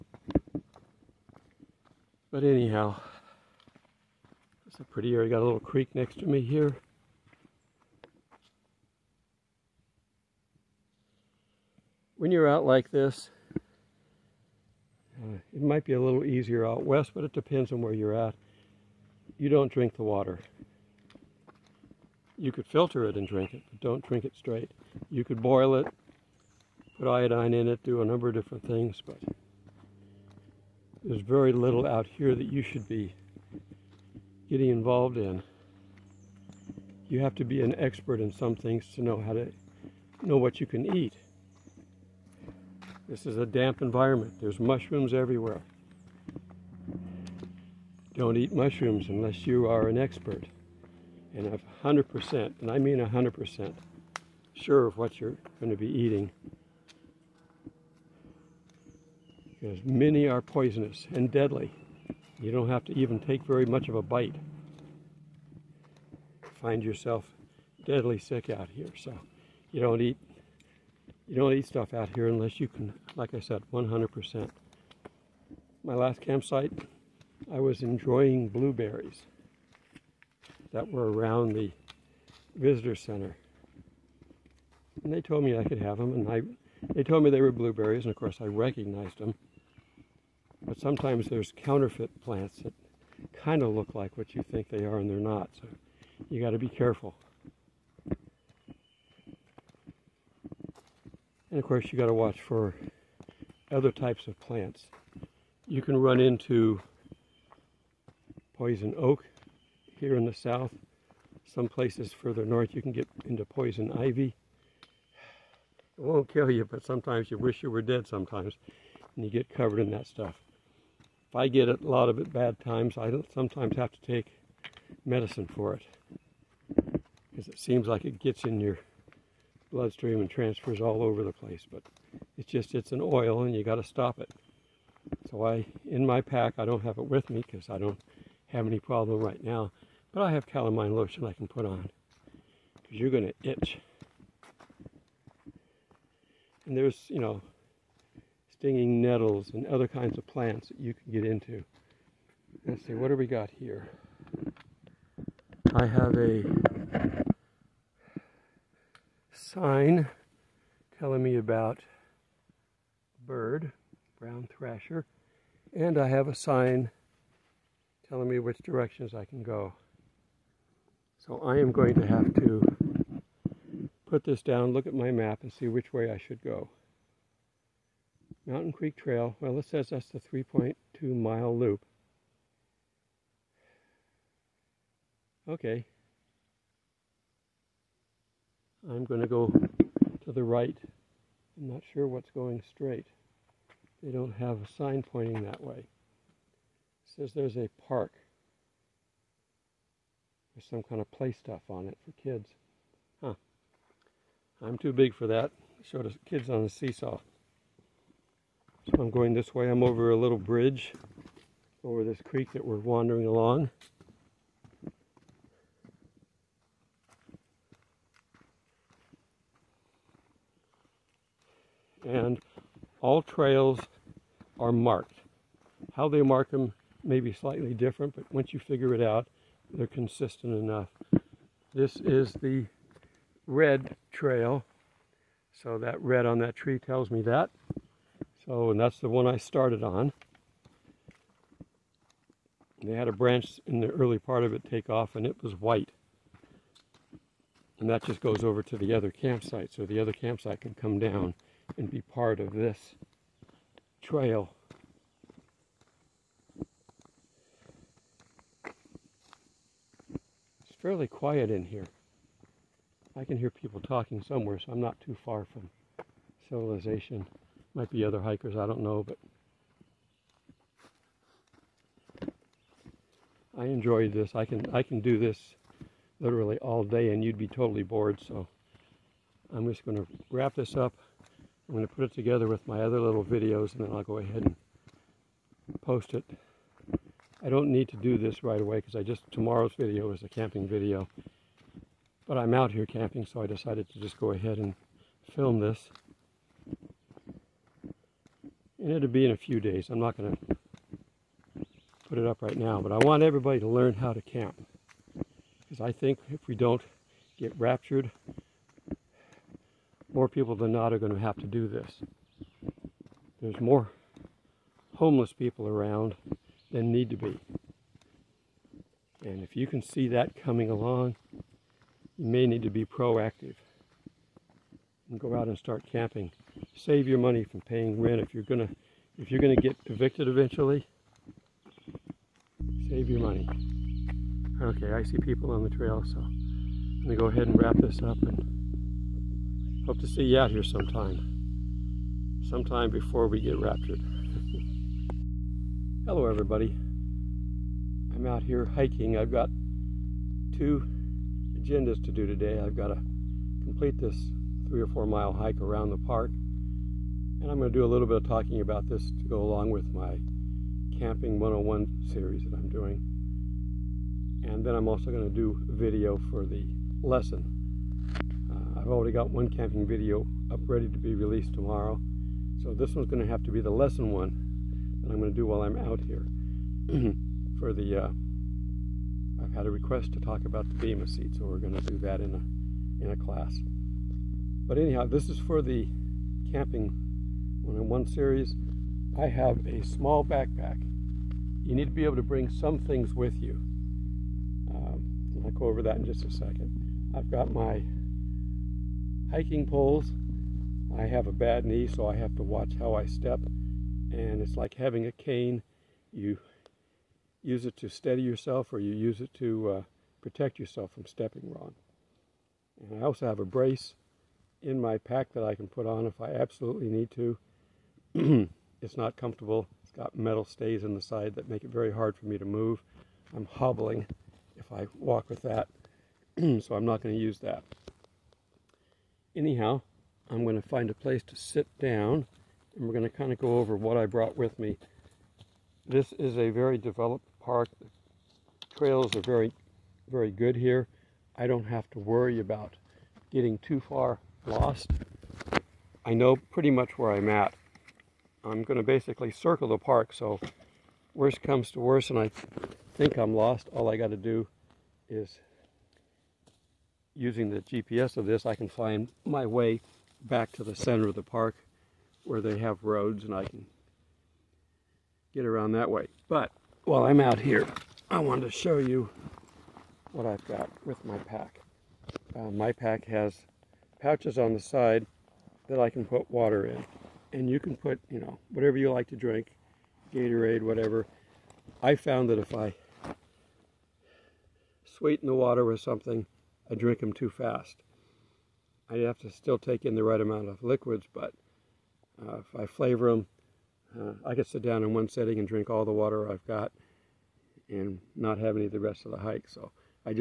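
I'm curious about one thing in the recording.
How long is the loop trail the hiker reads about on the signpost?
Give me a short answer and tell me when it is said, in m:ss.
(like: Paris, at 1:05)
3.2 miles, at 3:00.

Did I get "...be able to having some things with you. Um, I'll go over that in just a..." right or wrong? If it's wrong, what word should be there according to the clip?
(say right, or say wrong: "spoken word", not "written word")
wrong: "bring", not "having".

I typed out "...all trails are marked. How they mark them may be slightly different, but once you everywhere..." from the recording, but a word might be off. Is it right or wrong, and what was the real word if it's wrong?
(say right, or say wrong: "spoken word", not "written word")
wrong: "figure", not "everywhere".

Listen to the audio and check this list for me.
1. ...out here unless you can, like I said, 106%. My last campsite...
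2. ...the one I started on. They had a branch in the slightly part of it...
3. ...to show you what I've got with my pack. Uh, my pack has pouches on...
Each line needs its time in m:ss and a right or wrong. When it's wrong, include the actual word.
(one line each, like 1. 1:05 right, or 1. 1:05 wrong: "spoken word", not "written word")
1. 1:11 wrong: "100", not "106"
2. 3:58 wrong: "early", not "slightly"
3. 7:48 right.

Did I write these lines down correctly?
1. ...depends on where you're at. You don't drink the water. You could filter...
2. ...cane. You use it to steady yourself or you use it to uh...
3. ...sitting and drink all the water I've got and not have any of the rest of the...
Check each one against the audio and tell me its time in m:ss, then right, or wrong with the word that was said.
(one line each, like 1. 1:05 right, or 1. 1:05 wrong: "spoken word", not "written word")
1. 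0:17 right
2. 6:45 right
3. 8:15 right.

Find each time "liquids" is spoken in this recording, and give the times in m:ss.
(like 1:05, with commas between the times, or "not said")
8:10.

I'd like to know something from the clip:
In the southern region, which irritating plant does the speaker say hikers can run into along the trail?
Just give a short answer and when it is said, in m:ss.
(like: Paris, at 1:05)
Poison oak, at 1:48.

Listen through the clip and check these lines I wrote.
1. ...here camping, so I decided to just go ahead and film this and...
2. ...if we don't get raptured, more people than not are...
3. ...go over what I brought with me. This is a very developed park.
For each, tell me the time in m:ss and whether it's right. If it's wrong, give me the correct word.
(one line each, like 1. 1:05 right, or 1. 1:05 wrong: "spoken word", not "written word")
1. 4:52 right
2. 5:06 right
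3. 7:13 right.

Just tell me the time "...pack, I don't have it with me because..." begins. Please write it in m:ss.
2:16.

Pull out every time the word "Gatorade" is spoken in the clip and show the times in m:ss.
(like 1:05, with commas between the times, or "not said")
8:00.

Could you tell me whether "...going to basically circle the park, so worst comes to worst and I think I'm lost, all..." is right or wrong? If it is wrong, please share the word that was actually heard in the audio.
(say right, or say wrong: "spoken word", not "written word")
right.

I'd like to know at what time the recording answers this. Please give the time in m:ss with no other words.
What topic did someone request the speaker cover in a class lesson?
6:20.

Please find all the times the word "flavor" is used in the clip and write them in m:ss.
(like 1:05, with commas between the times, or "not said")
8:12.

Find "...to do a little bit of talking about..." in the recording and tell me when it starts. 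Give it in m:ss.
5:57.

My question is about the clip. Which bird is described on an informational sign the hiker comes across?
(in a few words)
Brown thrasher.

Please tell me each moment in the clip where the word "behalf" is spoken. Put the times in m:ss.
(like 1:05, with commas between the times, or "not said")
not said.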